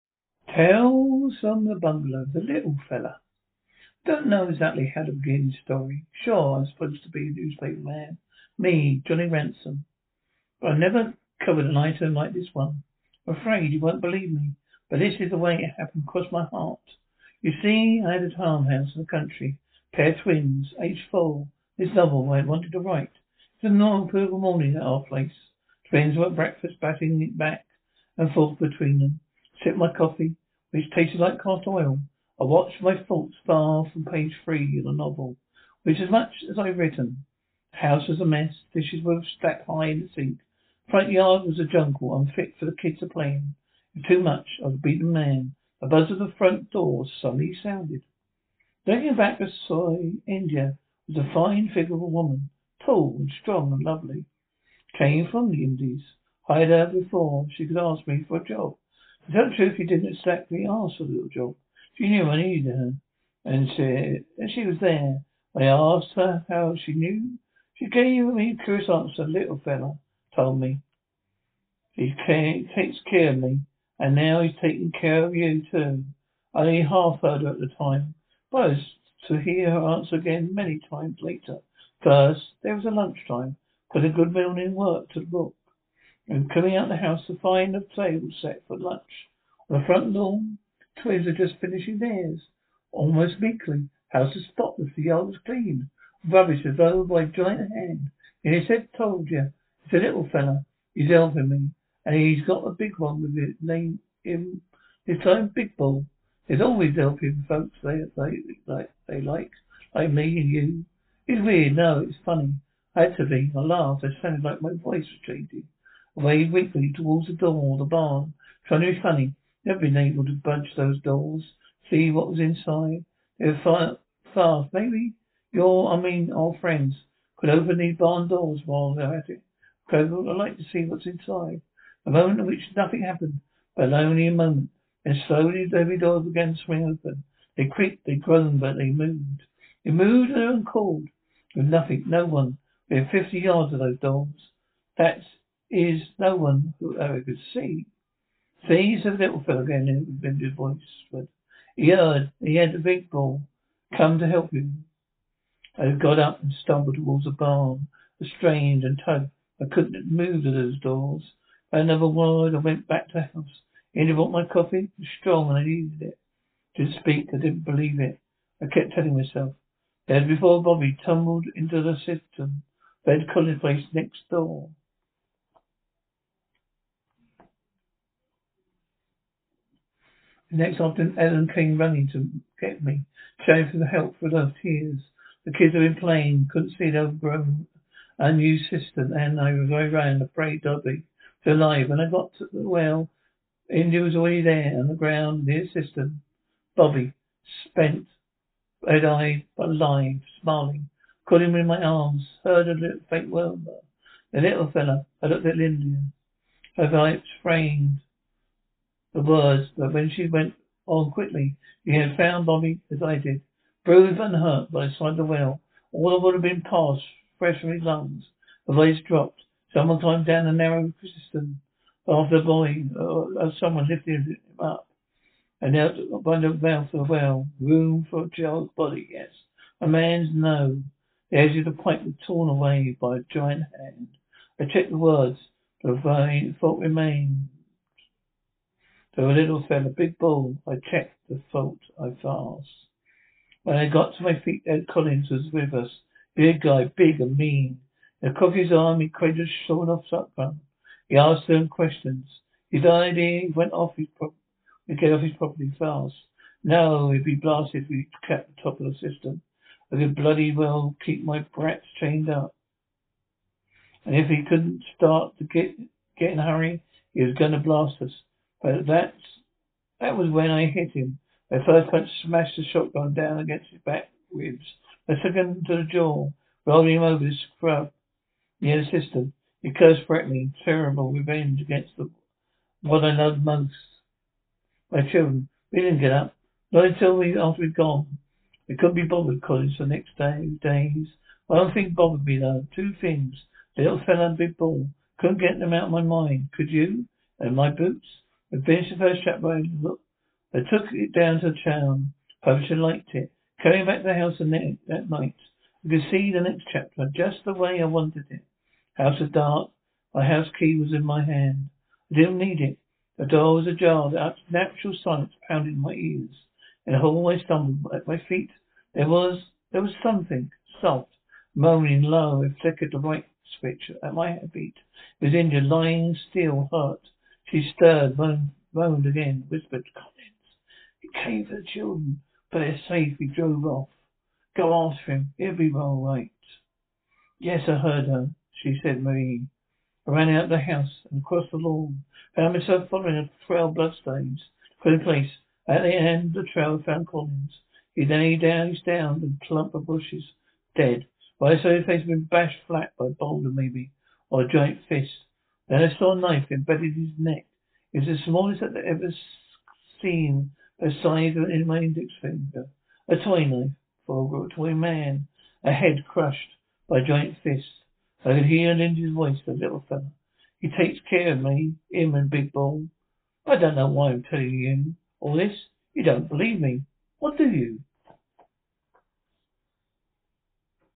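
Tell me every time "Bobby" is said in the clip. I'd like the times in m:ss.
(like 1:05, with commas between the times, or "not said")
2:50, 3:10, 3:16, 3:32.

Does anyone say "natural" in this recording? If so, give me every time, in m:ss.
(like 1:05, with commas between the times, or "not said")
5:14.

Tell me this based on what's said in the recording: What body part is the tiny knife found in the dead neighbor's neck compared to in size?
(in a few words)
Index finger.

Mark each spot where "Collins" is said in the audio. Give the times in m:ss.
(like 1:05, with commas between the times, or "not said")
2:53, 4:04, 5:47.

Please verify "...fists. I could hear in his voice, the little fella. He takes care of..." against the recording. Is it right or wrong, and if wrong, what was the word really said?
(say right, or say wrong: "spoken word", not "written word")
right.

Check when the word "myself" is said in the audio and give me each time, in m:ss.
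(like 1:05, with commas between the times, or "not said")
2:49, 5:42.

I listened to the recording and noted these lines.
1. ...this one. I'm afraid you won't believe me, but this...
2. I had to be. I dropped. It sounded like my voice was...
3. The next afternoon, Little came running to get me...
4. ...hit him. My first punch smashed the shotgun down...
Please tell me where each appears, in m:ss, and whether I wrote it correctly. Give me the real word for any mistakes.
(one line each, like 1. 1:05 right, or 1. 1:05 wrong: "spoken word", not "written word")
1. 0:12 right
2. 1:52 wrong: "laughed", not "dropped"
3. 3:00 wrong: "Ellen", not "Little"
4. 4:30 right.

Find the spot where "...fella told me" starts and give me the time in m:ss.
1:09.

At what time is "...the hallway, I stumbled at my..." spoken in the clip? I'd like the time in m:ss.
5:16.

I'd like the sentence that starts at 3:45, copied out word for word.
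And out by the mouth of the well, room for a child's body, yes.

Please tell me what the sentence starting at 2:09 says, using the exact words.
Credible, I'd like to see what's inside.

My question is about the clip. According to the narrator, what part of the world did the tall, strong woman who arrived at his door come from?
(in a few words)
The Indies.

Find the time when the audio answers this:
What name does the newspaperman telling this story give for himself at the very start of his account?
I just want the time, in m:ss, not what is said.
0:09.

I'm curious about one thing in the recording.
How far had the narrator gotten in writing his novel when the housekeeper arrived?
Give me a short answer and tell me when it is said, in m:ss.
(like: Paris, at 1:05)
Page 3, at 0:34.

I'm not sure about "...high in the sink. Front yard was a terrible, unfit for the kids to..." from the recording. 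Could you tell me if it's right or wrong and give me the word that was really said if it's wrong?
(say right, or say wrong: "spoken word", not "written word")
wrong: "jungle", not "terrible".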